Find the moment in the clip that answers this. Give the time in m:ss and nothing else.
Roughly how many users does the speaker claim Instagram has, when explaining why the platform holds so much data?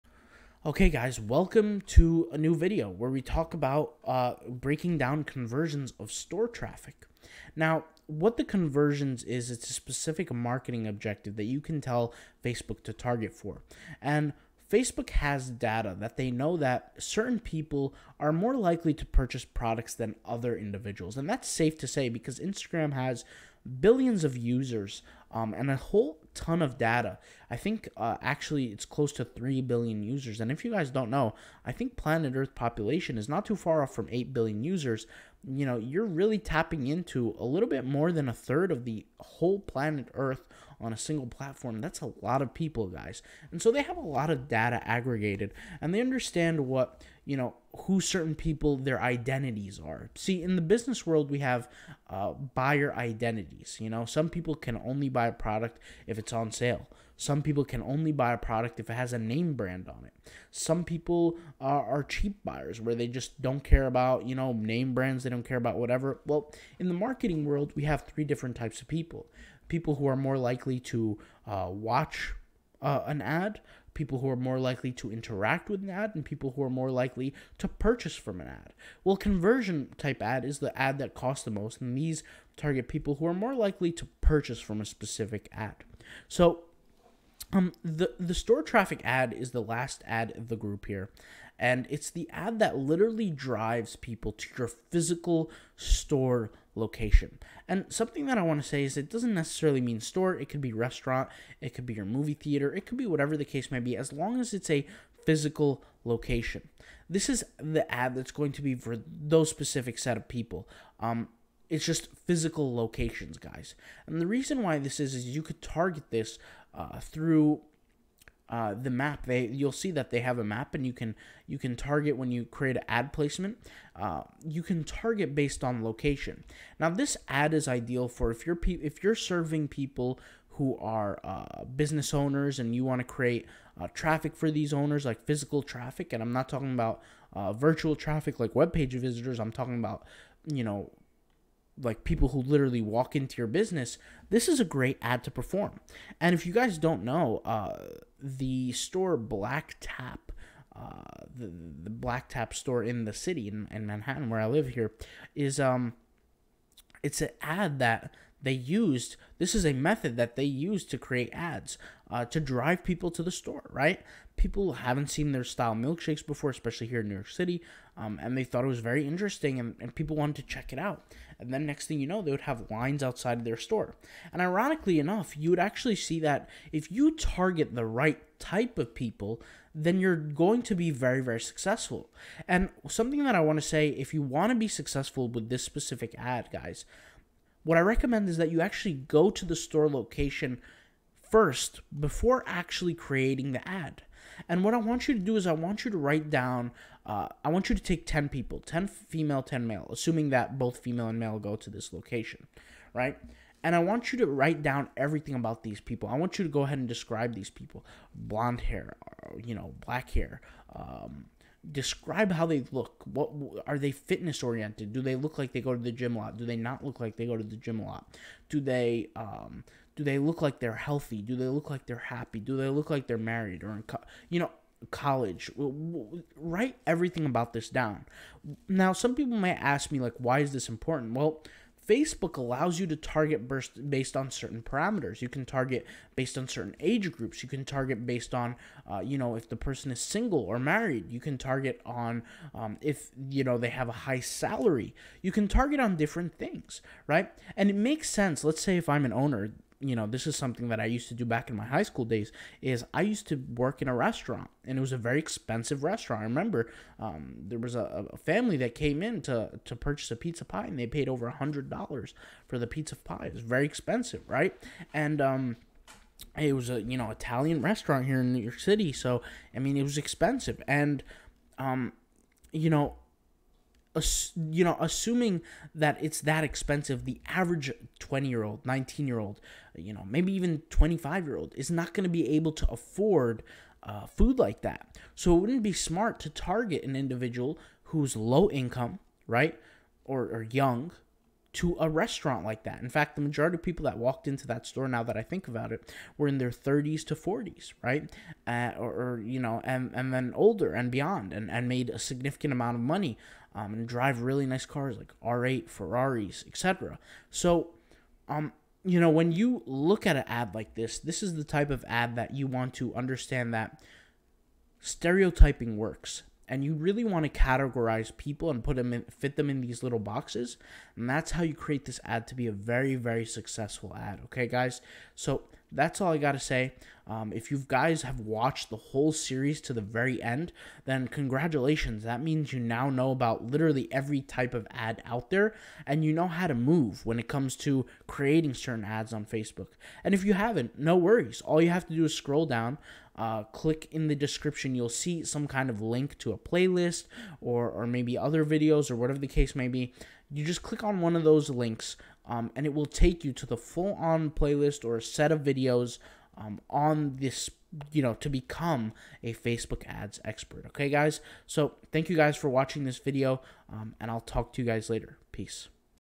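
0:28.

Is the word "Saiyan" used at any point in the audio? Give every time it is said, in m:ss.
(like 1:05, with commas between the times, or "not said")
not said.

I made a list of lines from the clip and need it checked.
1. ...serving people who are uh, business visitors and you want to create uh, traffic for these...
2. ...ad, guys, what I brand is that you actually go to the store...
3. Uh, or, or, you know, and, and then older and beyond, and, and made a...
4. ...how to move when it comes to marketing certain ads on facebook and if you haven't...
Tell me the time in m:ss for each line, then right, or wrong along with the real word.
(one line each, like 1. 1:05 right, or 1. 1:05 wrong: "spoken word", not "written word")
1. 2:09 wrong: "owners", not "visitors"
2. 3:06 wrong: "recommend", not "brand"
3. 4:58 right
4. 5:36 wrong: "creating", not "marketing".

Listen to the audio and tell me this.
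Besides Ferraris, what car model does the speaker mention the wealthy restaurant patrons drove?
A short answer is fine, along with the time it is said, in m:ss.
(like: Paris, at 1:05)
R8, at 5:05.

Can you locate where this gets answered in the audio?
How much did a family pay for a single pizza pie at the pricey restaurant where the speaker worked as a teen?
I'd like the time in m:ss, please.
4:21.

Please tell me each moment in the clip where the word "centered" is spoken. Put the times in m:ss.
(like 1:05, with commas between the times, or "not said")
not said.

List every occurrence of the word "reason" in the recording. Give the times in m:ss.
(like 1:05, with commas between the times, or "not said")
1:54.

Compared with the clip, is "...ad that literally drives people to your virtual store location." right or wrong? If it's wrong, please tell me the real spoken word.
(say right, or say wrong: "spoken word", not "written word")
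wrong: "physical", not "virtual".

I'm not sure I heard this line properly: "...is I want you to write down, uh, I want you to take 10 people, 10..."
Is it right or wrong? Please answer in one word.
right.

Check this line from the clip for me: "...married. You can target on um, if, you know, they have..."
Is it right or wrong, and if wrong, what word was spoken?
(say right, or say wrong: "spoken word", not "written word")
right.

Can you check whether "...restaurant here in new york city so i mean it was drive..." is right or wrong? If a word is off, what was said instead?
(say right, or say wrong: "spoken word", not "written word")
wrong: "expensive", not "drive".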